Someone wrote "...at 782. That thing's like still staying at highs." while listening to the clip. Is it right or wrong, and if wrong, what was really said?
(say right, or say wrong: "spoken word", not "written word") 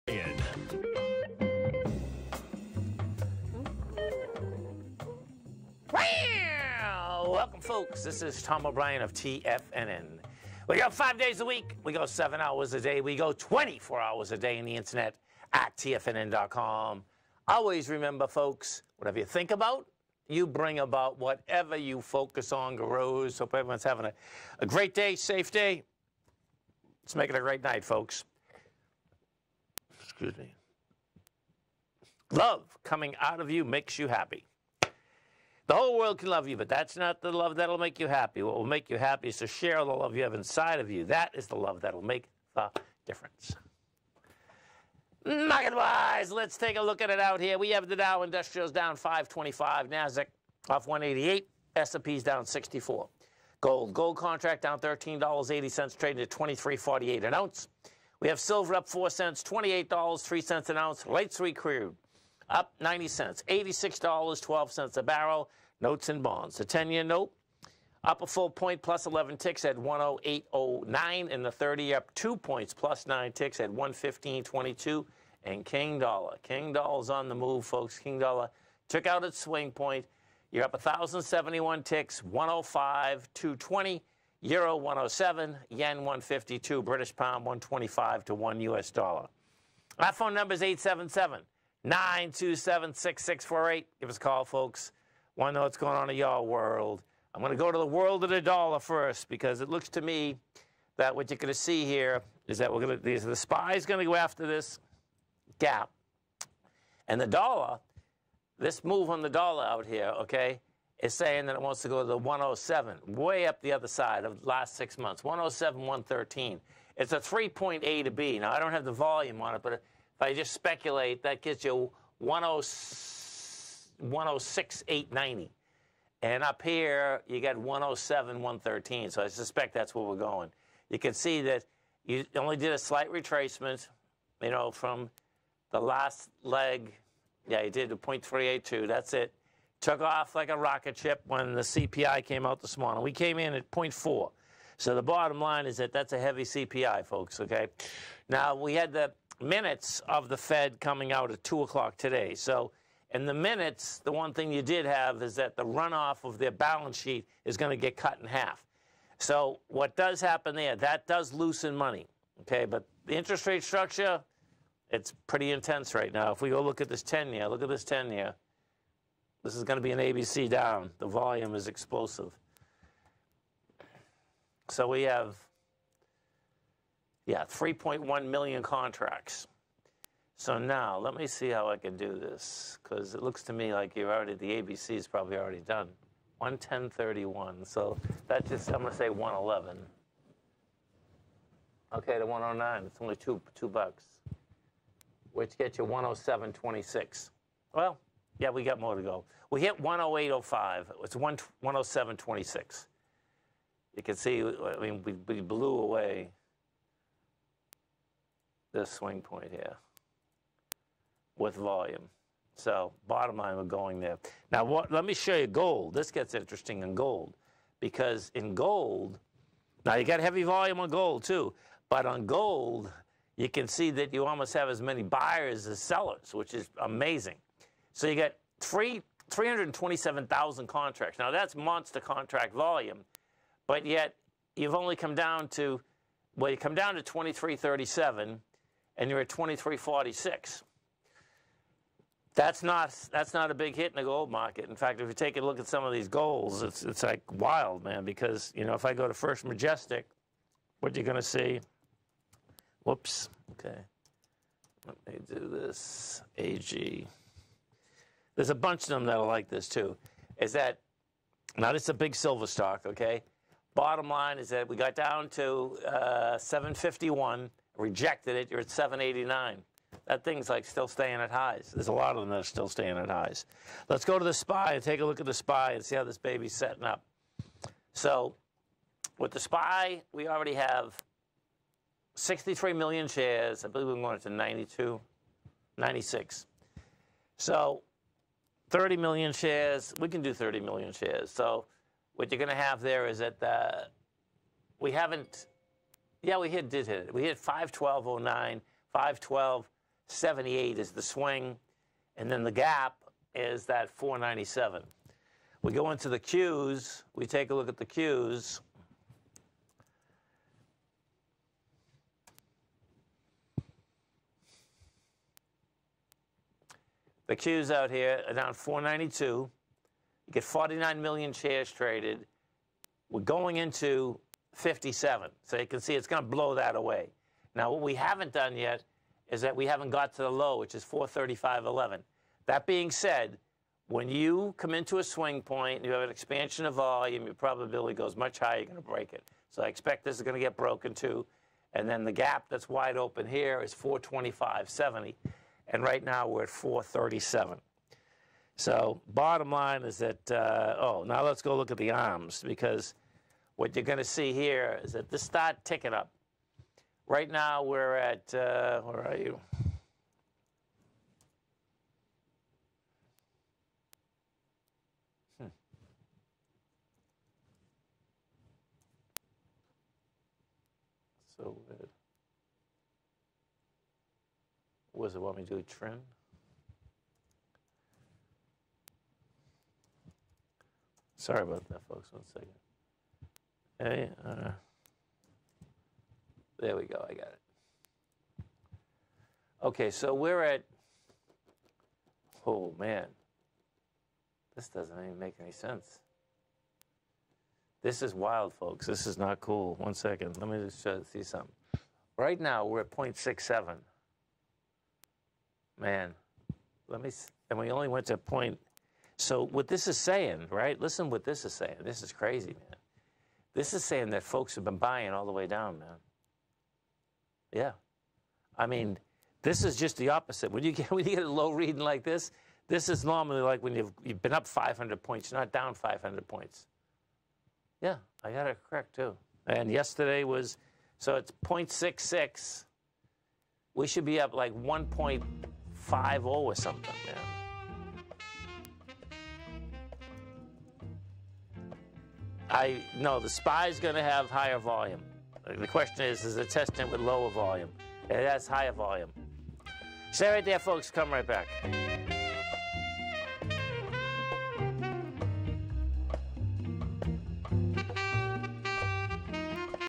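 wrong: "789", not "782".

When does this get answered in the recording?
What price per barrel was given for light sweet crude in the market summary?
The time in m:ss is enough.
1:03.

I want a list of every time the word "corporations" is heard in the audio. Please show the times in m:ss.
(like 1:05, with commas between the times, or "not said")
not said.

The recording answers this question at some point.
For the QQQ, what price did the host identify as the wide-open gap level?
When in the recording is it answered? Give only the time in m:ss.
5:43.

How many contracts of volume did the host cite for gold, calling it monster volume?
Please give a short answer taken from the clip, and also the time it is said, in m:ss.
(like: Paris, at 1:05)
327,000, at 3:49.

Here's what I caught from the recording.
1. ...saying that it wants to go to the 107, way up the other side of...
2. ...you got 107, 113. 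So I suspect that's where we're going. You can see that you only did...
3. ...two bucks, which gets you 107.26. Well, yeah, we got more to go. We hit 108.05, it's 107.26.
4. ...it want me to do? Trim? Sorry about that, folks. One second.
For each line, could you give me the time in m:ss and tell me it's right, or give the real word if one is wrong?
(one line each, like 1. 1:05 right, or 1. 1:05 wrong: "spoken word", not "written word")
1. 1:51 right
2. 2:07 right
3. 3:13 right
4. 6:15 right.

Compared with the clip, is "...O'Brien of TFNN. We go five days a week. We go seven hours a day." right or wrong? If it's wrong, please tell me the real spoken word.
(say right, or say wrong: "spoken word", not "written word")
right.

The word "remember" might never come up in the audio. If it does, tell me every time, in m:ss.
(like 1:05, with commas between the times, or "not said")
0:17.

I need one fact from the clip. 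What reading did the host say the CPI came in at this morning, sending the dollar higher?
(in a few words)
0.4.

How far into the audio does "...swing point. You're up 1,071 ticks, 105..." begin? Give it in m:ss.
1:19.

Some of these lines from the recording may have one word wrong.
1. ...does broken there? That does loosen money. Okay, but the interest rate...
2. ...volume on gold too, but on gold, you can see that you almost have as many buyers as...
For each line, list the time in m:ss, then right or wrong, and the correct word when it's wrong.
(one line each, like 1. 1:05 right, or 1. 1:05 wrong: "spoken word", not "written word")
1. 2:39 wrong: "happen", not "broken"
2. 3:40 right.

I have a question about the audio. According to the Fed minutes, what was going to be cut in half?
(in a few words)
The runoff of their balance sheet.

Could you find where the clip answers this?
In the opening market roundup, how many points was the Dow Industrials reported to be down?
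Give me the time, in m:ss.
0:48.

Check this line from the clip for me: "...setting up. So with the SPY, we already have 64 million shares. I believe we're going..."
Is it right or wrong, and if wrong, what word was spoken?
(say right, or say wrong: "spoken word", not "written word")
wrong: "63", not "64".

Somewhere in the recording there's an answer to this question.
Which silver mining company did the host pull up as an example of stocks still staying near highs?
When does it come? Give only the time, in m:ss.
4:09.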